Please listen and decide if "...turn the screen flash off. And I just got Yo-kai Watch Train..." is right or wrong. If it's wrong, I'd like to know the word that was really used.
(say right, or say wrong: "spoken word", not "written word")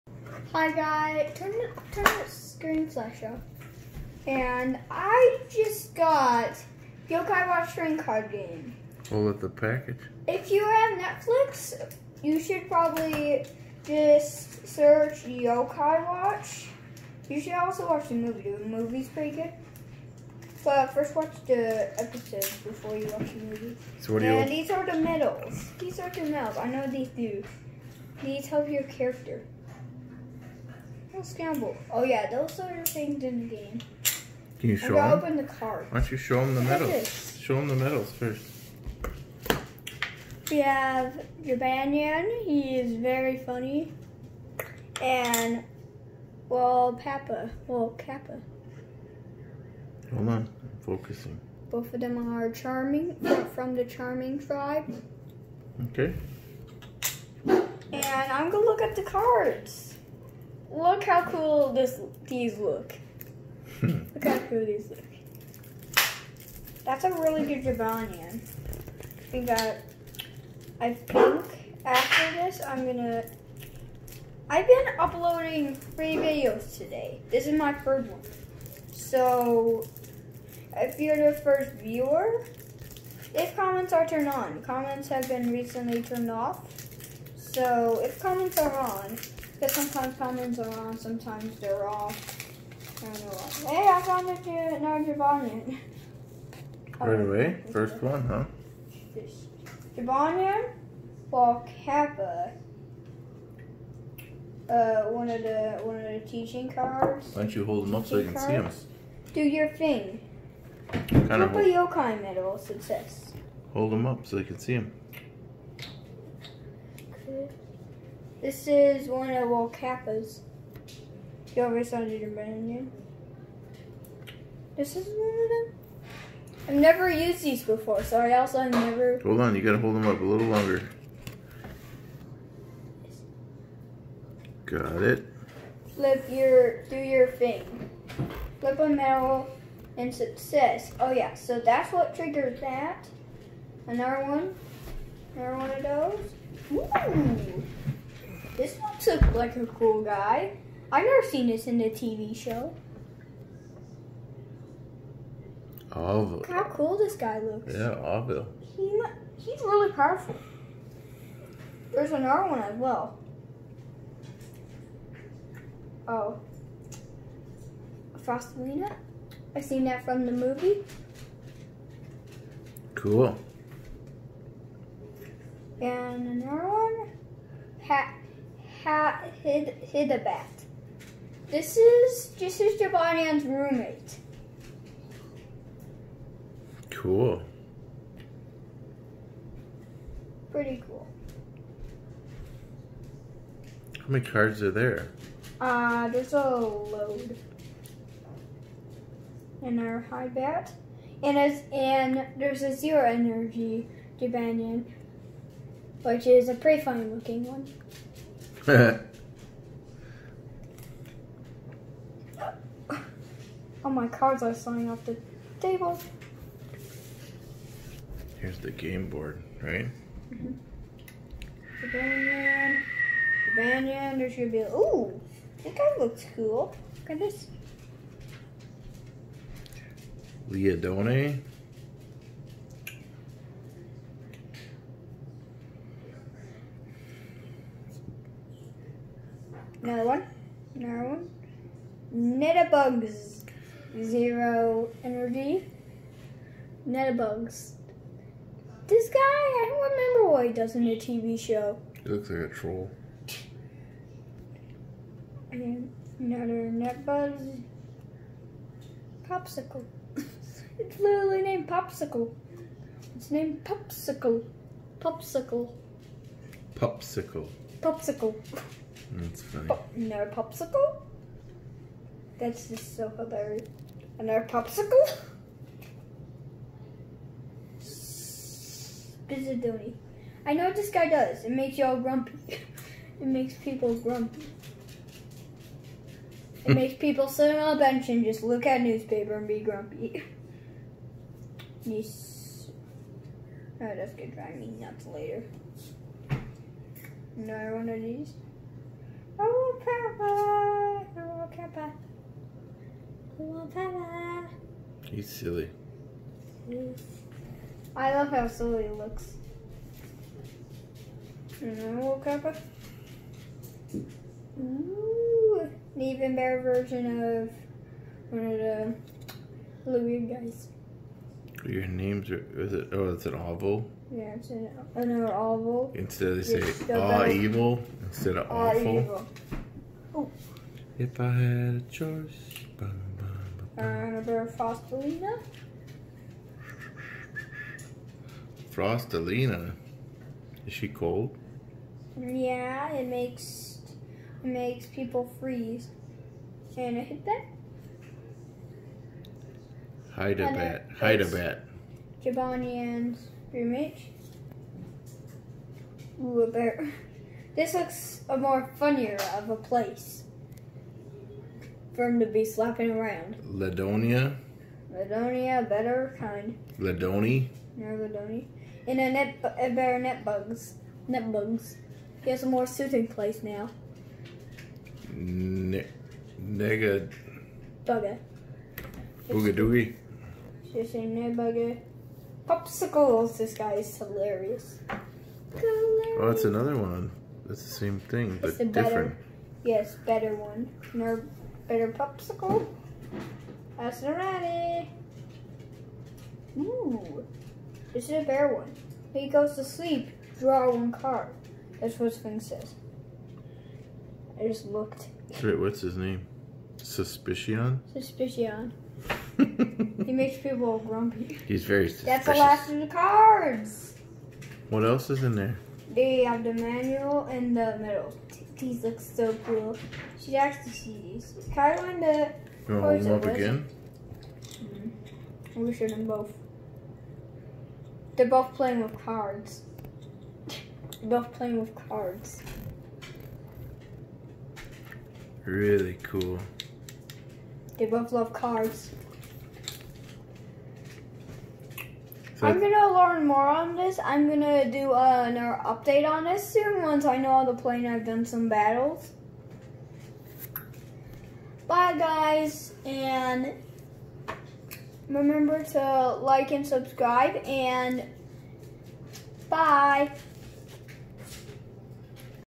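right.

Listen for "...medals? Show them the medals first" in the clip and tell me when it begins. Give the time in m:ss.
0:36.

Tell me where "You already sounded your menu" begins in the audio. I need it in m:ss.
2:01.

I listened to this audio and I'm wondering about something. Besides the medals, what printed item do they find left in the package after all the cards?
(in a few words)
The manual.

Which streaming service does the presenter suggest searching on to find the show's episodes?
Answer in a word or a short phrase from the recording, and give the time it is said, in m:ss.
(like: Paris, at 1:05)
Netflix, at 0:10.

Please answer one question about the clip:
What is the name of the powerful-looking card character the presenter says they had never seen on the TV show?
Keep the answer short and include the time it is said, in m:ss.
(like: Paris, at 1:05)
Orville, at 2:37.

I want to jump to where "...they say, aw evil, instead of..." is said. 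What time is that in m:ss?
5:26.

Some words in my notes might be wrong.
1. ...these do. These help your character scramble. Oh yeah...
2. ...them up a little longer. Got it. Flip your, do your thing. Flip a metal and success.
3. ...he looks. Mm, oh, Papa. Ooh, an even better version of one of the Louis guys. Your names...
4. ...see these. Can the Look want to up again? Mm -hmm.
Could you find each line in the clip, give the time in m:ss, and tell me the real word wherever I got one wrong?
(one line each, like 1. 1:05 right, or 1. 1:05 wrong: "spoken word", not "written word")
1. 0:26 right
2. 2:09 right
3. 5:08 right
4. 7:00 wrong: "You", not "Look".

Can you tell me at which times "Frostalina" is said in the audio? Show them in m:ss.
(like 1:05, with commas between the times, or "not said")
2:48, 5:34, 5:38.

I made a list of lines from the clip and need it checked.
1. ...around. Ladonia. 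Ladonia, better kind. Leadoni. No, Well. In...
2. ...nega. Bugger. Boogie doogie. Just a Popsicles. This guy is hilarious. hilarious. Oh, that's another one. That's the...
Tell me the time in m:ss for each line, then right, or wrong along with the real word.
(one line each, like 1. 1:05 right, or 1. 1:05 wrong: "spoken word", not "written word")
1. 6:02 wrong: "Leadoni", not "Well"
2. 6:16 right.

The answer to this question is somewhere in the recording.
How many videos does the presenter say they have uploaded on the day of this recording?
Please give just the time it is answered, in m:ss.
1:15.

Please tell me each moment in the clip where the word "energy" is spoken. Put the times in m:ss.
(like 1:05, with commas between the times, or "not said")
3:23, 4:05.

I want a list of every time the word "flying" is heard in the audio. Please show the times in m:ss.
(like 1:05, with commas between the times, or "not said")
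3:34.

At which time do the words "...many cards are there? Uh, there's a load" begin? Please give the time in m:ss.
3:14.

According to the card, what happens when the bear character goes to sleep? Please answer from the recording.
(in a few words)
Draw one card.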